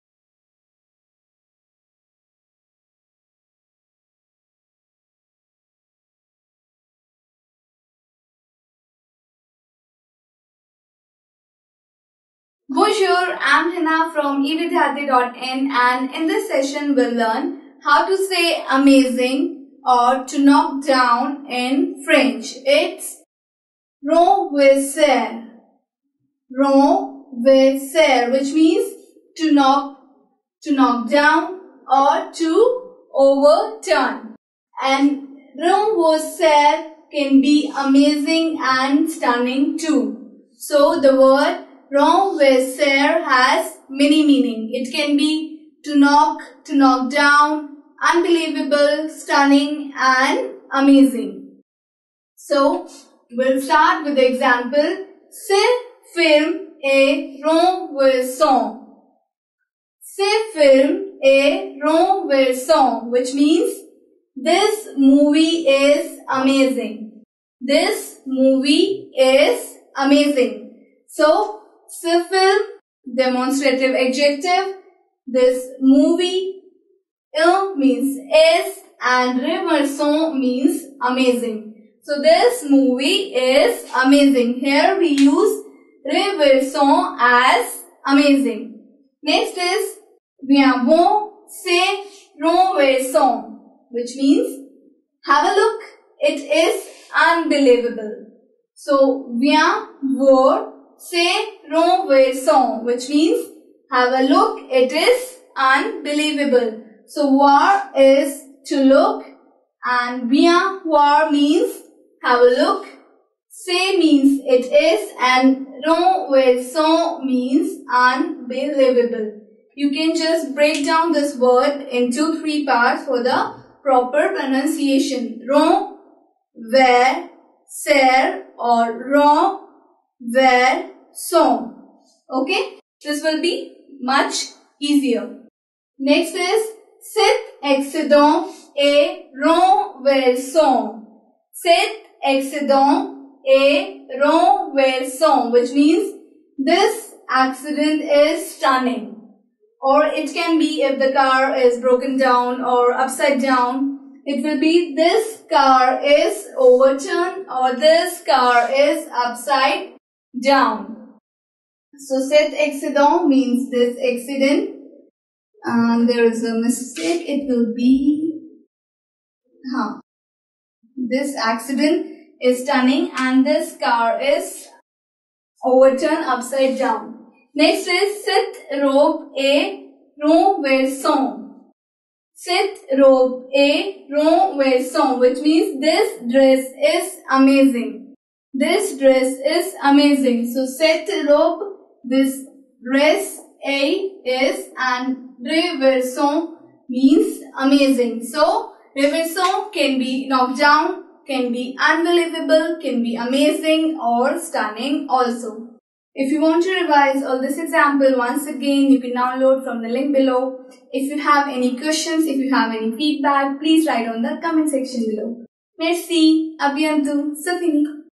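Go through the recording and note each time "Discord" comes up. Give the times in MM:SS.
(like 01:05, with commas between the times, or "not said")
not said.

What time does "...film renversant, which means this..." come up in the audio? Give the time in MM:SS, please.
01:00.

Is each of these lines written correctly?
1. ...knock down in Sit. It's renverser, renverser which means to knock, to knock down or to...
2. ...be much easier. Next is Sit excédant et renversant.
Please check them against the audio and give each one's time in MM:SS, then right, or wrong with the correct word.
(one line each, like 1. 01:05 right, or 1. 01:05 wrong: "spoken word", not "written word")
1. 00:20 wrong: "French", not "Sit"
2. 02:13 right.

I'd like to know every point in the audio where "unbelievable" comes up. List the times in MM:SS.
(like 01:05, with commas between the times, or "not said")
00:48, 01:37, 01:45, 01:57, 03:21.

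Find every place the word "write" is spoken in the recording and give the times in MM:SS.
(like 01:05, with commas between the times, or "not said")
03:33.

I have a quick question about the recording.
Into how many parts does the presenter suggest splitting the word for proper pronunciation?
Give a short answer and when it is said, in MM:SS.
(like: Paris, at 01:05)
3, at 02:02.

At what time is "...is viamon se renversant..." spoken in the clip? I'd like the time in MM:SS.
01:29.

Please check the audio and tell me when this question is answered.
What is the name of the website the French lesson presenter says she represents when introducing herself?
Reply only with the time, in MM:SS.
00:14.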